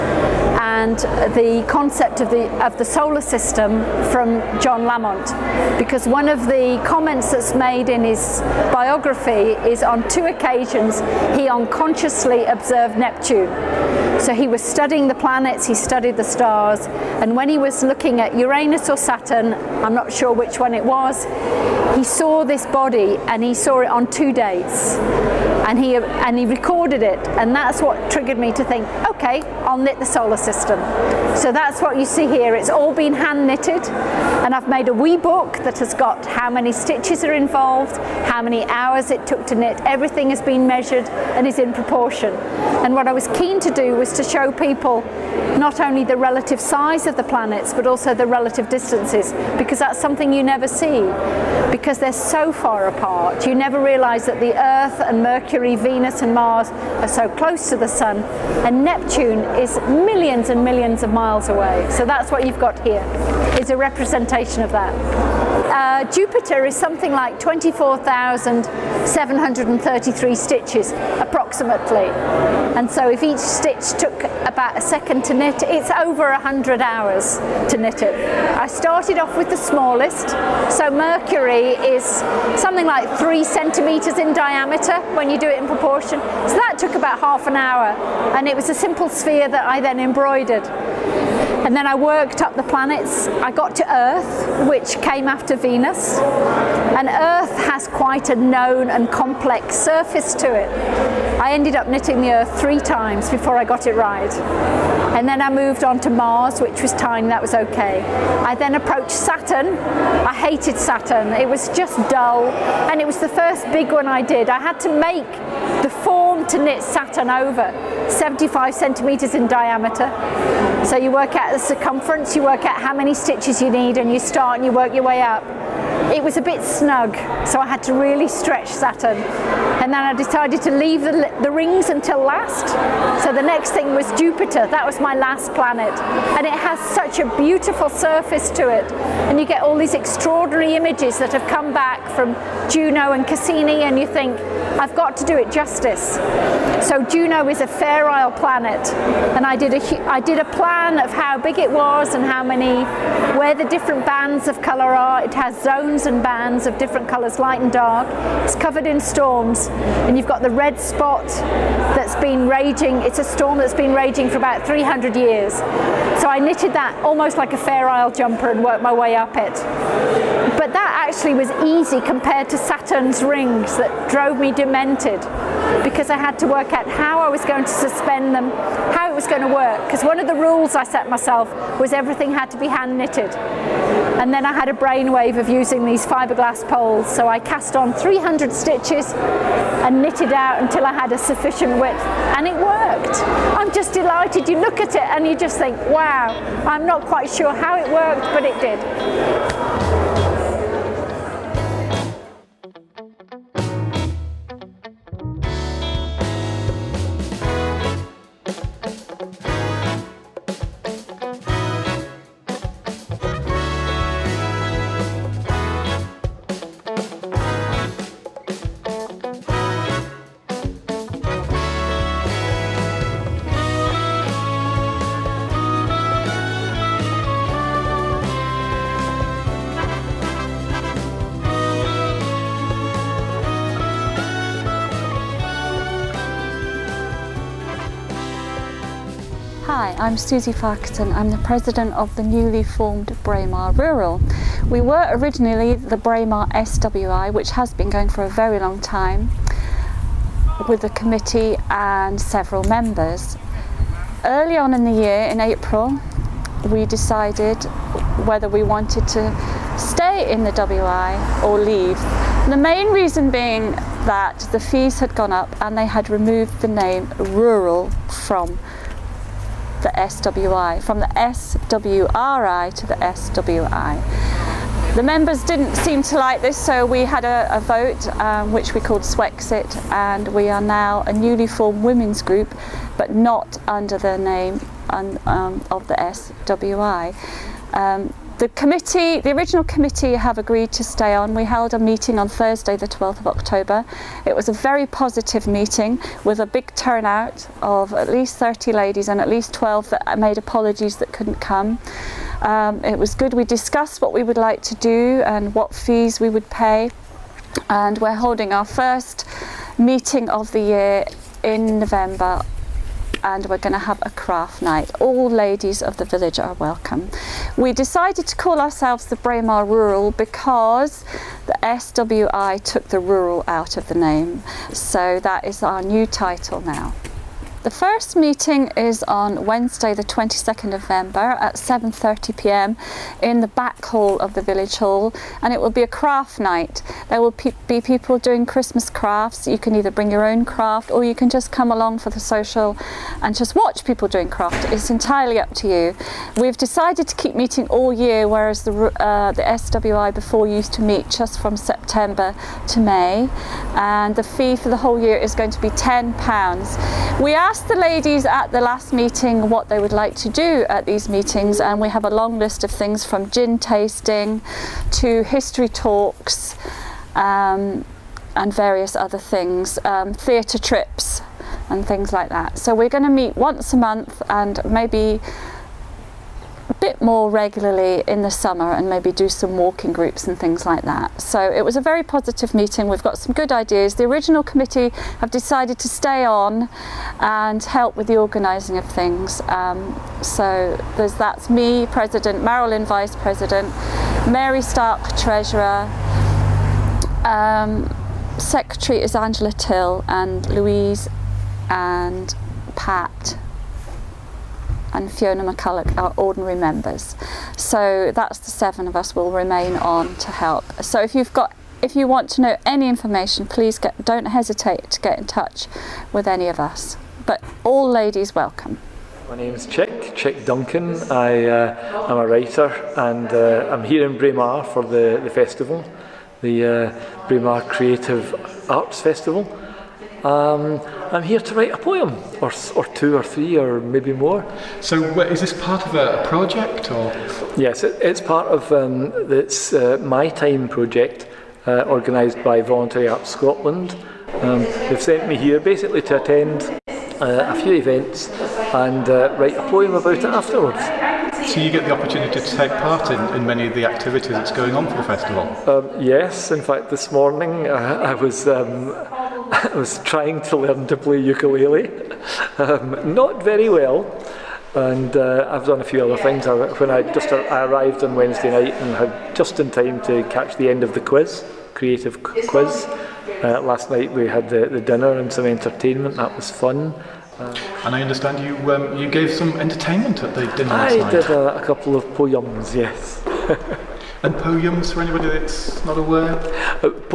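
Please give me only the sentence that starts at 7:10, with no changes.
Um, I'm here to write a poem, or, or two, or three, or maybe more.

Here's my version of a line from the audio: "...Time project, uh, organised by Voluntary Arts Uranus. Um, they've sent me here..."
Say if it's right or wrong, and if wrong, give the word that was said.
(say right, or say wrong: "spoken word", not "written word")
wrong: "Scotland", not "Uranus".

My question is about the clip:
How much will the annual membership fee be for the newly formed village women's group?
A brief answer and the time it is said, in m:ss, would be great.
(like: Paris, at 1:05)
£10, at 5:55.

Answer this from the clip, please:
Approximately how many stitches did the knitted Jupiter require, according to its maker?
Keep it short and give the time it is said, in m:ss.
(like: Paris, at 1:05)
24,733, at 1:07.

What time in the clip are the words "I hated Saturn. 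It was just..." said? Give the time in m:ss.
1:50.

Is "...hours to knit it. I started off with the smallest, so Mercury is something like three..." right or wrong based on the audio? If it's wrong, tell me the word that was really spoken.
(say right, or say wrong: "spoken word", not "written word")
right.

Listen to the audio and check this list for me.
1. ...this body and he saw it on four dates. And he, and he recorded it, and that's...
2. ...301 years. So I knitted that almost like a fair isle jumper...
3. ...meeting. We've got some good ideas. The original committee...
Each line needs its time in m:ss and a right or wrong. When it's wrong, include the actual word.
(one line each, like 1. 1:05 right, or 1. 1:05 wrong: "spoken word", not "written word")
1. 0:22 wrong: "two", not "four"
2. 2:44 wrong: "300", not "301"
3. 6:22 right.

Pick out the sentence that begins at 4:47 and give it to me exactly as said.
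Um, the committee, the original committee have agreed to stay on.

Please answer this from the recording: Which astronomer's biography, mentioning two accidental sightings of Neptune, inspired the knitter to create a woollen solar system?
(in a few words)
John Lamont.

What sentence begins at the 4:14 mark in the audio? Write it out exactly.
Early on in the year, in April, we decided whether we wanted to stay in the WI or leave.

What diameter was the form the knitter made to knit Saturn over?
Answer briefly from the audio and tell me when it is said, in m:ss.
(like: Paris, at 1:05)
75 centimetres, at 1:58.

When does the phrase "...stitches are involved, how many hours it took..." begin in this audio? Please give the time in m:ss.
0:36.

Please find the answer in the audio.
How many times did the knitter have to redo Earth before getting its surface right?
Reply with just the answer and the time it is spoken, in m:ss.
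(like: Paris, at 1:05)
3, at 1:42.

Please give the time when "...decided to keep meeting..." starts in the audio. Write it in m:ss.
5:46.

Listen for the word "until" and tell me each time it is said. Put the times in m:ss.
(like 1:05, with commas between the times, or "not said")
2:11, 3:10.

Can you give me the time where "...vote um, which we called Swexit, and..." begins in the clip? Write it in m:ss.
4:37.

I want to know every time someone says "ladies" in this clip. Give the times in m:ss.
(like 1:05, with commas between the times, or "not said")
4:58, 5:15, 5:57, 6:57.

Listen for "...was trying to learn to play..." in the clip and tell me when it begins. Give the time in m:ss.
7:39.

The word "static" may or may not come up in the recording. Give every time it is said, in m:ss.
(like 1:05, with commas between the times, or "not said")
not said.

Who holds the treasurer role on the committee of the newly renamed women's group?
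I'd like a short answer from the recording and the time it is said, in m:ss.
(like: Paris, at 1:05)
Mary Stark, at 6:34.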